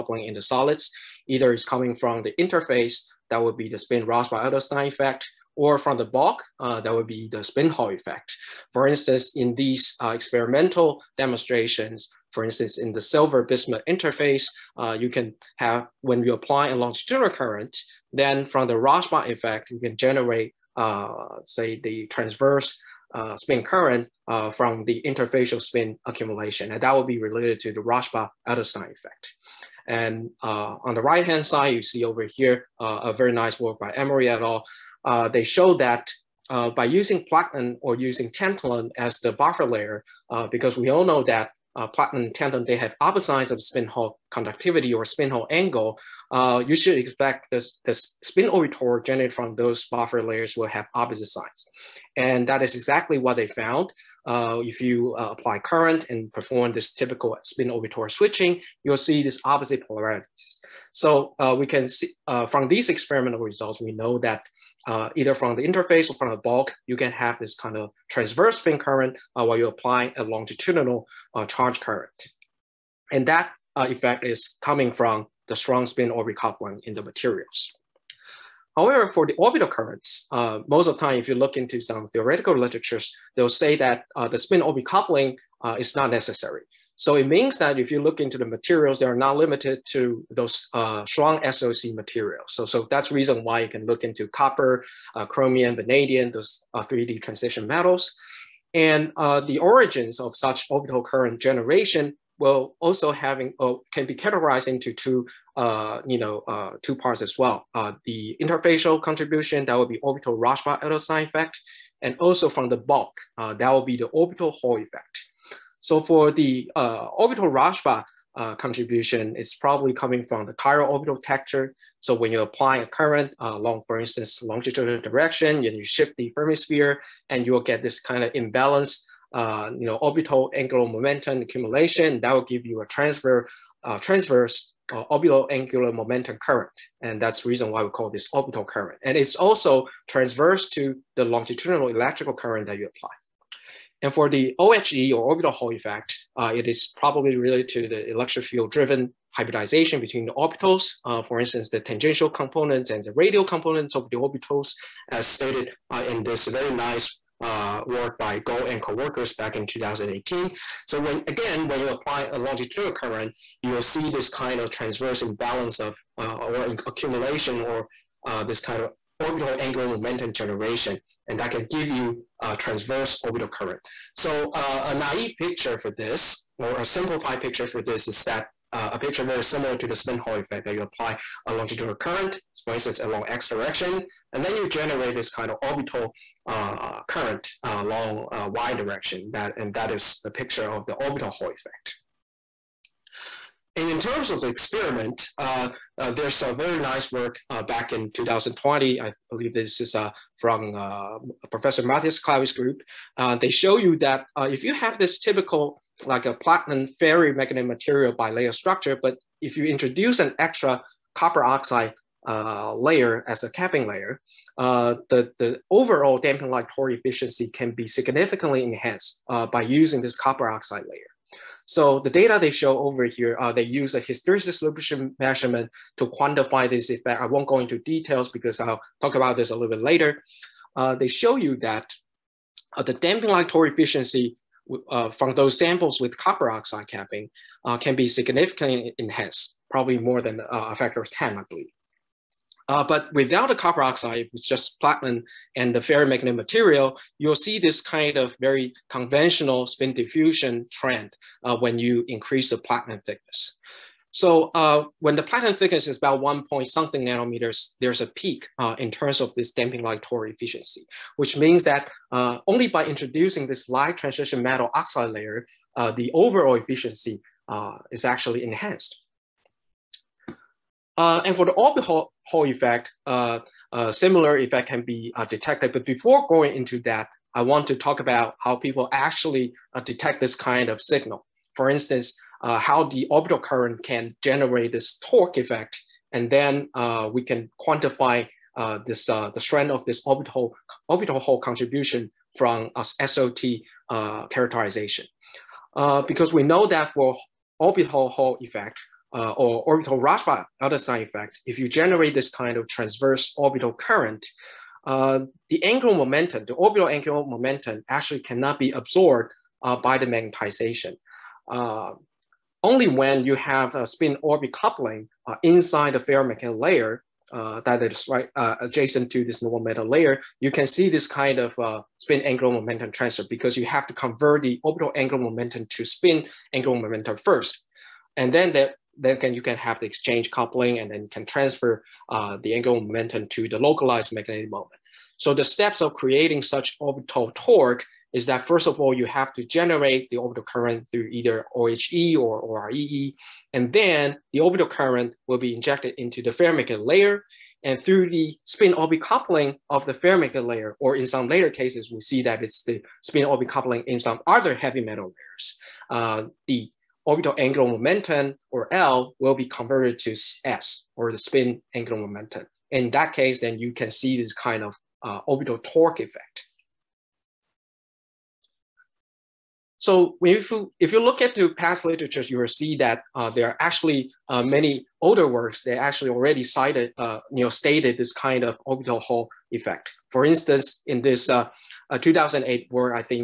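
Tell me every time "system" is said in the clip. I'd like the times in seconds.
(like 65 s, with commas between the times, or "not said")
not said.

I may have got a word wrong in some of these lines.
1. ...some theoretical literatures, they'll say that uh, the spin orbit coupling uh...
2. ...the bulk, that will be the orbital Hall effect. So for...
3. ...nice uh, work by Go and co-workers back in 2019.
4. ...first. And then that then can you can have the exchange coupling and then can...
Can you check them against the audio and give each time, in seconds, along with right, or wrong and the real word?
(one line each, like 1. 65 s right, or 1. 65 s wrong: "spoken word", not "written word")
1. 81 s right
2. 112 s right
3. 156 s wrong: "2018", not "2019"
4. 327 s right.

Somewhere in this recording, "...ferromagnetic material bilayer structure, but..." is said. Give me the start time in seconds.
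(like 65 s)
206 s.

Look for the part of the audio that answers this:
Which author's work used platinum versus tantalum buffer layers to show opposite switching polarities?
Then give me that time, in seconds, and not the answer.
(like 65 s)
33 s.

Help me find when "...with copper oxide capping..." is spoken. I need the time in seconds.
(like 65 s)
235 s.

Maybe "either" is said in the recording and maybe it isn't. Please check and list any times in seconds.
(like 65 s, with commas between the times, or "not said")
1 s, 65 s, 341 s.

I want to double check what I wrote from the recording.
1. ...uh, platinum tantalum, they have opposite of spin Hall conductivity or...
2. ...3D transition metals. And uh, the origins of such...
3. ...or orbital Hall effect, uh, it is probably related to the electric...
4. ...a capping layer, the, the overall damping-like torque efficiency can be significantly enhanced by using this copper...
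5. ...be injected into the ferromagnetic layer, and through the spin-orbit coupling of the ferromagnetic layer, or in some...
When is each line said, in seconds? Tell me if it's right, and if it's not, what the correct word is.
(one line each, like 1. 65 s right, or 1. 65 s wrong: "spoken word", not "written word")
1. 41 s right
2. 96 s right
3. 145 s right
4. 213 s right
5. 345 s right.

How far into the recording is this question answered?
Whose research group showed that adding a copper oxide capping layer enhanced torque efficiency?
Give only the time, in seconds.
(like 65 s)
201 s.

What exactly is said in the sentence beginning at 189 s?
That, and that is the picture of the orbital Hall effect.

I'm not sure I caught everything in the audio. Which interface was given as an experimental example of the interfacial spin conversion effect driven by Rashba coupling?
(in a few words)
Silver bismuth.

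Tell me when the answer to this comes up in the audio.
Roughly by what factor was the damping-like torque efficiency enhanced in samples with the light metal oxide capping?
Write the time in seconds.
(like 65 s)
240 s.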